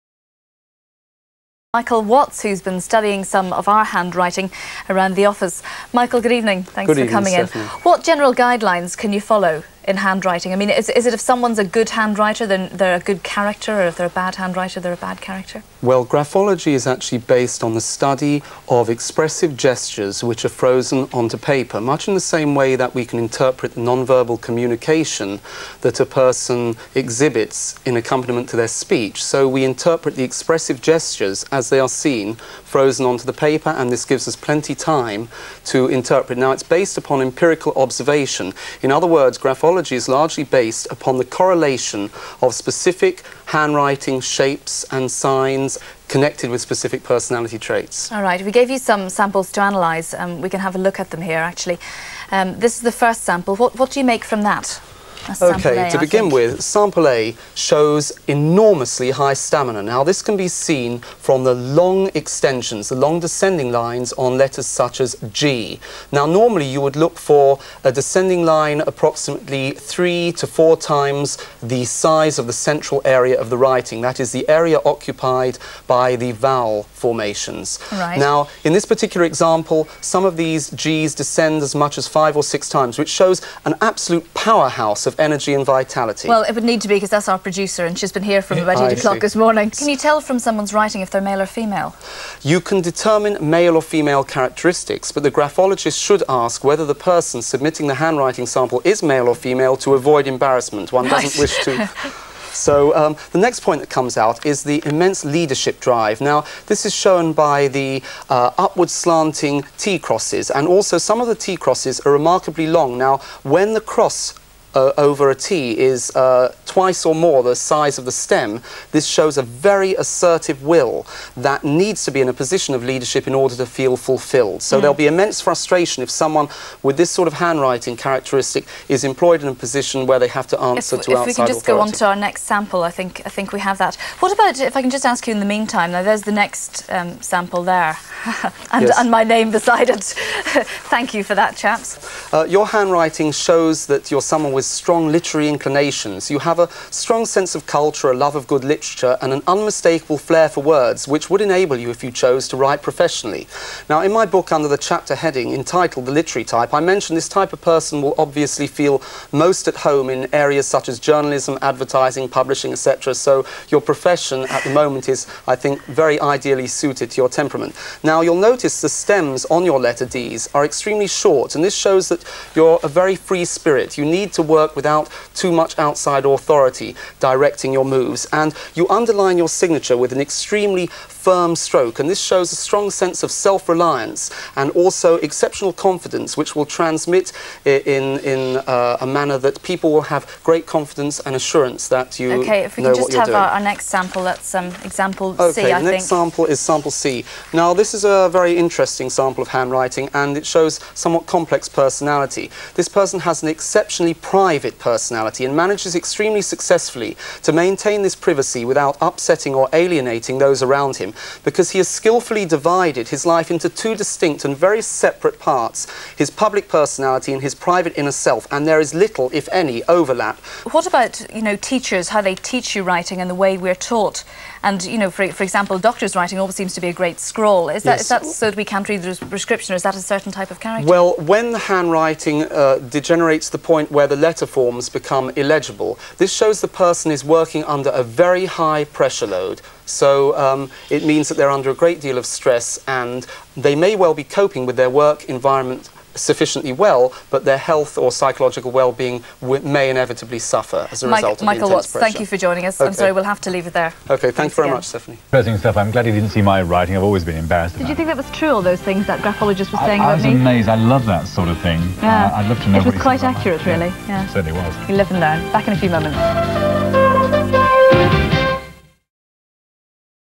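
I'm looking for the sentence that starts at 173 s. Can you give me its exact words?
You need to work without too much outside authority directing your moves.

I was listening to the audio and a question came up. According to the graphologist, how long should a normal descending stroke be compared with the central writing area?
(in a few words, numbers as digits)
3 to 4 times.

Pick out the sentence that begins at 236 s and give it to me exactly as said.
This shows the person is working under a very high pressure load.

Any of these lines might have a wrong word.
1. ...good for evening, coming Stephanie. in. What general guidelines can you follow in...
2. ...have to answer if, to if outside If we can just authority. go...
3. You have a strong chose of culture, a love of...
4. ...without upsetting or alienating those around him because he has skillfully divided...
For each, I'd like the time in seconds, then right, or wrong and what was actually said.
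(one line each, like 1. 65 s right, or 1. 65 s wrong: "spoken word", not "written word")
1. 6 s right
2. 130 s right
3. 146 s wrong: "sense", not "chose"
4. 208 s right.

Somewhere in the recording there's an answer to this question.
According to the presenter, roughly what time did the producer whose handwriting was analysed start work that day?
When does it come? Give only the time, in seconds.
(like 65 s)
88 s.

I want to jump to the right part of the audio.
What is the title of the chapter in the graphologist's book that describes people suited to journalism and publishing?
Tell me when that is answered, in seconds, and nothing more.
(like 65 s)
156 s.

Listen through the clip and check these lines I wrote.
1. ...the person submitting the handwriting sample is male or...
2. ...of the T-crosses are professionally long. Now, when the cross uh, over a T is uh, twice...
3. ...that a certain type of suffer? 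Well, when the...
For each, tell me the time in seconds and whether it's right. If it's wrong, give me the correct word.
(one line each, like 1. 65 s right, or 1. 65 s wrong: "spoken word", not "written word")
1. 96 s right
2. 111 s wrong: "remarkably", not "professionally"
3. 229 s wrong: "character", not "suffer".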